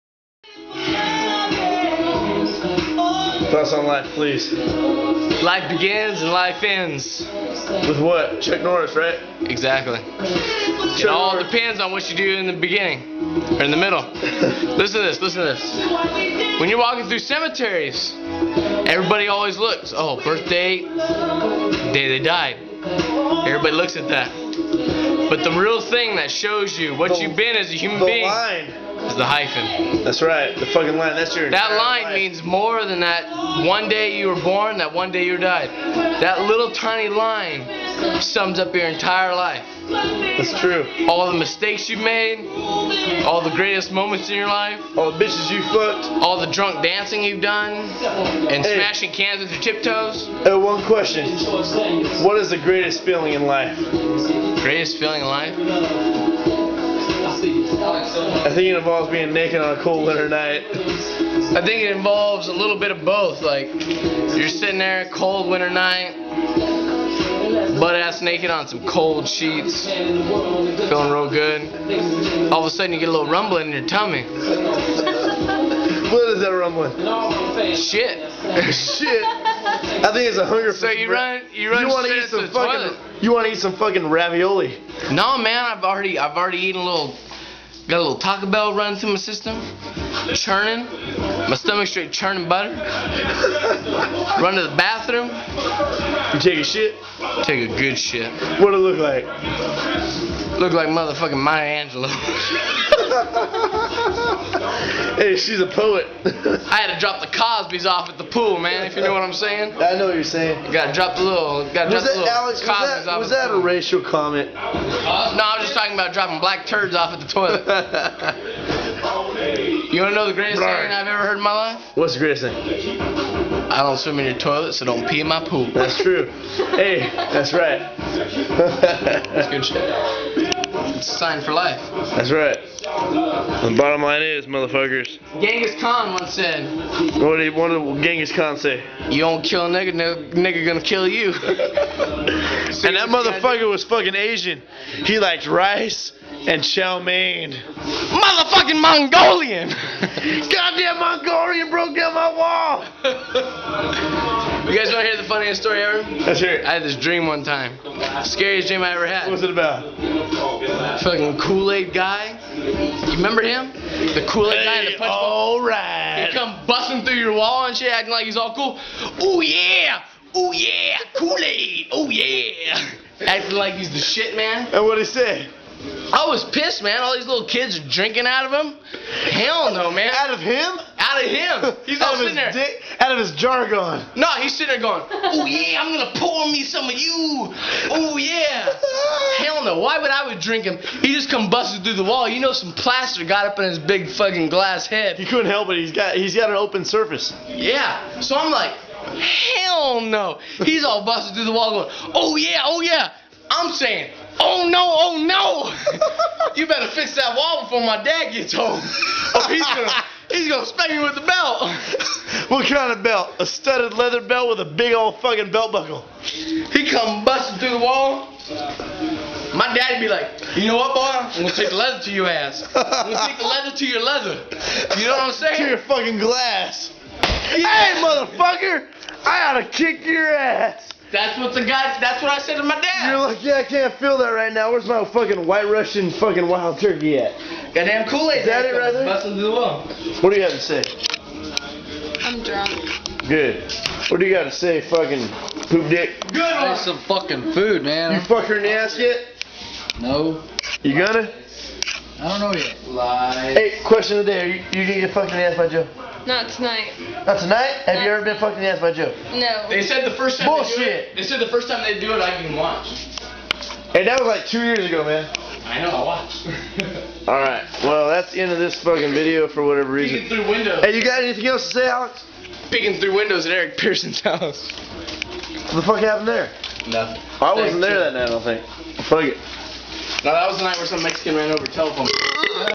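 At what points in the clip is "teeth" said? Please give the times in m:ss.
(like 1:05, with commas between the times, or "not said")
not said.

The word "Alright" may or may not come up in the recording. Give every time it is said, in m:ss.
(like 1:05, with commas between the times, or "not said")
2:45, 4:27.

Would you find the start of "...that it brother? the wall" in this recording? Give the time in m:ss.
3:58.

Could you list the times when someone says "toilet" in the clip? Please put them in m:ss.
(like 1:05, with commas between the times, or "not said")
1:22, 1:57, 2:04.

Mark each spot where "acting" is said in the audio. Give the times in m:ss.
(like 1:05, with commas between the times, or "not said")
2:47, 2:53.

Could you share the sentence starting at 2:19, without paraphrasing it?
You don't kill a nigga, no, nigga gonna kill you.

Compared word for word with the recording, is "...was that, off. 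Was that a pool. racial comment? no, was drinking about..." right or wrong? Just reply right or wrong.
wrong.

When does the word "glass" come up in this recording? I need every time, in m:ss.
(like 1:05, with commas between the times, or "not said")
3:14, 3:46.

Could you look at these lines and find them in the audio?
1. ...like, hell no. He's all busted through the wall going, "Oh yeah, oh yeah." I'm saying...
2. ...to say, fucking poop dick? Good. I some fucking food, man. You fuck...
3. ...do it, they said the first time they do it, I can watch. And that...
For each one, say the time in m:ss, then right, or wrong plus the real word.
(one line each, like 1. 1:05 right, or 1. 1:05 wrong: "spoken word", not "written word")
1. 3:18 right
2. 4:04 right
3. 4:20 right.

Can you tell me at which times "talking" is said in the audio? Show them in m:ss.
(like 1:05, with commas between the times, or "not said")
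1:55.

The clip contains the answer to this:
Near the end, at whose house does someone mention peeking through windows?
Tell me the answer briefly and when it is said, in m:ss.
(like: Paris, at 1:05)
Eric Pearson's, at 4:33.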